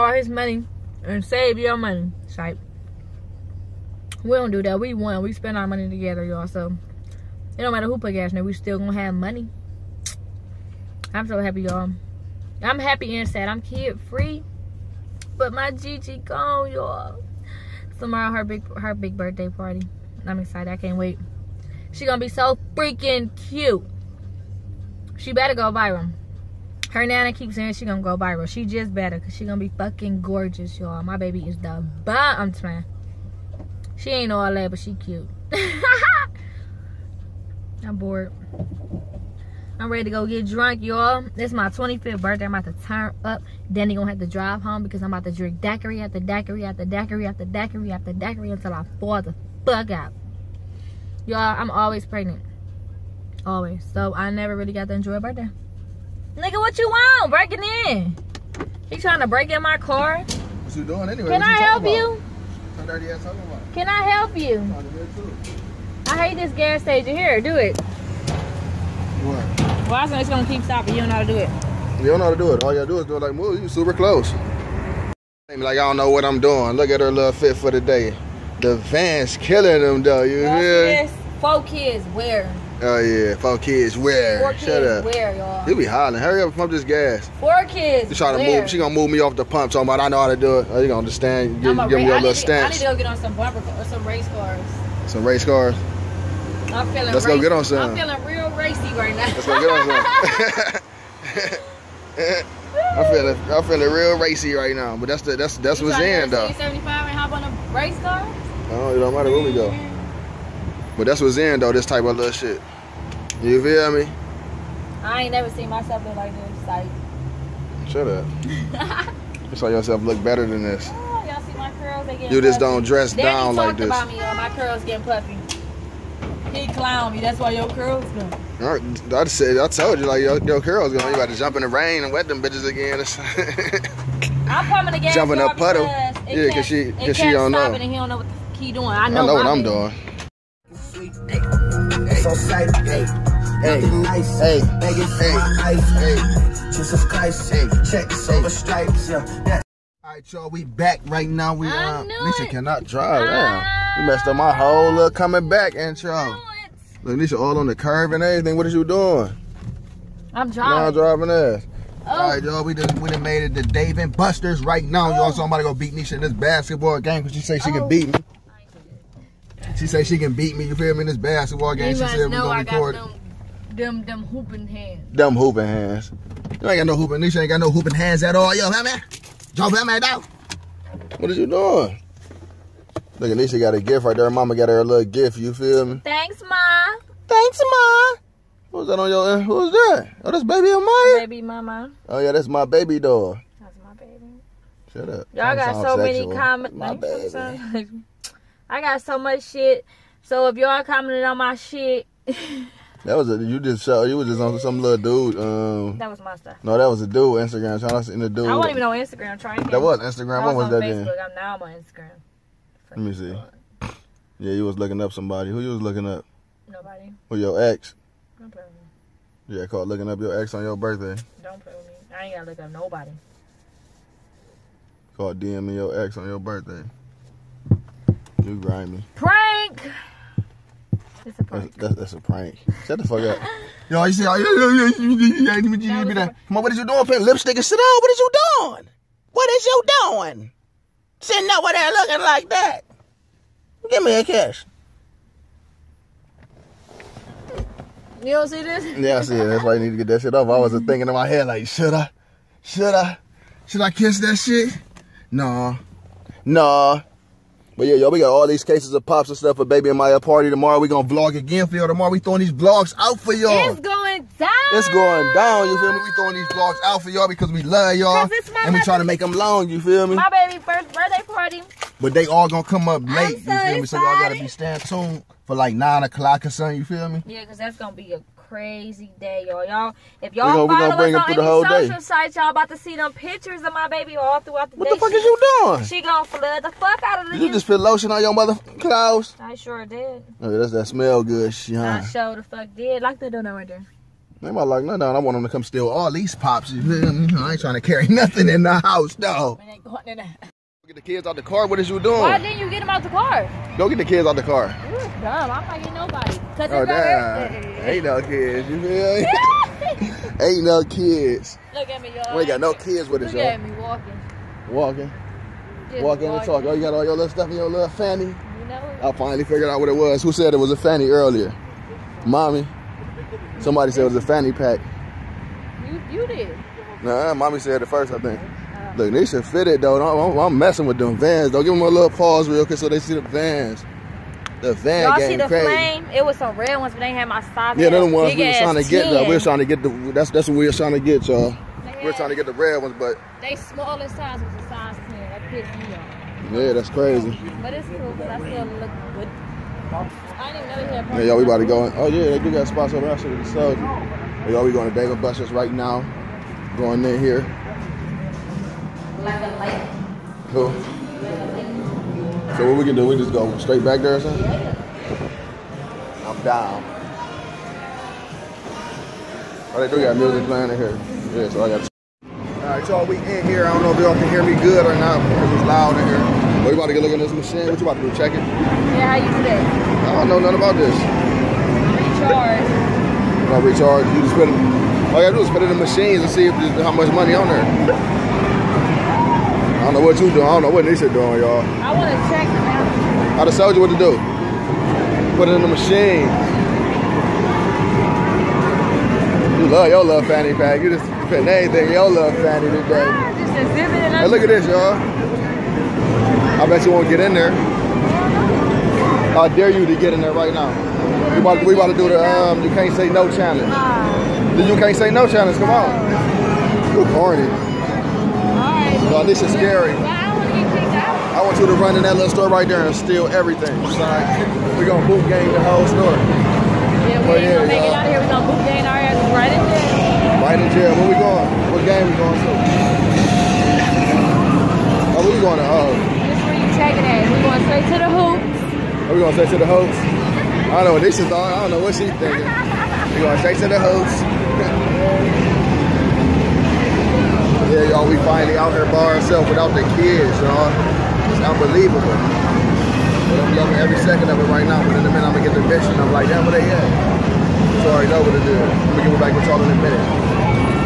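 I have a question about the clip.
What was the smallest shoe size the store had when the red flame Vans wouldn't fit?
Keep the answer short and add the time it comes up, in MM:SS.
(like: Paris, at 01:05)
10, at 05:44.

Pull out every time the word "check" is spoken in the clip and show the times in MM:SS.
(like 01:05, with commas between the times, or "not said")
06:18, 06:32.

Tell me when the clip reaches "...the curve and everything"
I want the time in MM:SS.
02:37.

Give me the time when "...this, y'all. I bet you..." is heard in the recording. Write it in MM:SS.
06:44.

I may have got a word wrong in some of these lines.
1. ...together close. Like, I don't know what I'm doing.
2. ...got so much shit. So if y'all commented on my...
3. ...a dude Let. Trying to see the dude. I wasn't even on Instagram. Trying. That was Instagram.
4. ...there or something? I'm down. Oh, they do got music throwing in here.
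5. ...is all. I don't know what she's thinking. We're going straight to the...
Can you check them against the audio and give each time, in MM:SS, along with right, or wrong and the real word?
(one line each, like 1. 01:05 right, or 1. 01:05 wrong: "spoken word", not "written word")
1. 01:13 wrong: "super", not "together"
2. 03:18 right
3. 03:27 wrong: "Instagram", not "Let"
4. 06:04 wrong: "playing", not "throwing"
5. 07:21 right.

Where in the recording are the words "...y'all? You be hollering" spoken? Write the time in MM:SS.
01:25.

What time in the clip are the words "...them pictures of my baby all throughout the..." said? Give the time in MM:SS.
04:42.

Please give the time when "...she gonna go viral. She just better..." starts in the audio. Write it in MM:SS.
00:27.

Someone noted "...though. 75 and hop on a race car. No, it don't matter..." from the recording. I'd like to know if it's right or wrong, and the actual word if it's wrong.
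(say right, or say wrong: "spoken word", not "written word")
right.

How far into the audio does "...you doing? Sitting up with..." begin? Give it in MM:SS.
03:59.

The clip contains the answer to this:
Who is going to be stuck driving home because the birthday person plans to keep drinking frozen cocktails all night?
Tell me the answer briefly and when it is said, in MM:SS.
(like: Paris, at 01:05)
Danny, at 00:43.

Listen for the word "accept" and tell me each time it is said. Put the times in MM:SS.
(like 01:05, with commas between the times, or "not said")
not said.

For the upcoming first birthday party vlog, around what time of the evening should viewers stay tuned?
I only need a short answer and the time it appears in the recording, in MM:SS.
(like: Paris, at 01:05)
9 o'clock, at 04:35.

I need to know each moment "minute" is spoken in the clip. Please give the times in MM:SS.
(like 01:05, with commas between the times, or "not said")
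07:35, 07:39.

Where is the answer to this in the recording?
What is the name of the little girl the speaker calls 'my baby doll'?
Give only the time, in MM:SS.
03:10.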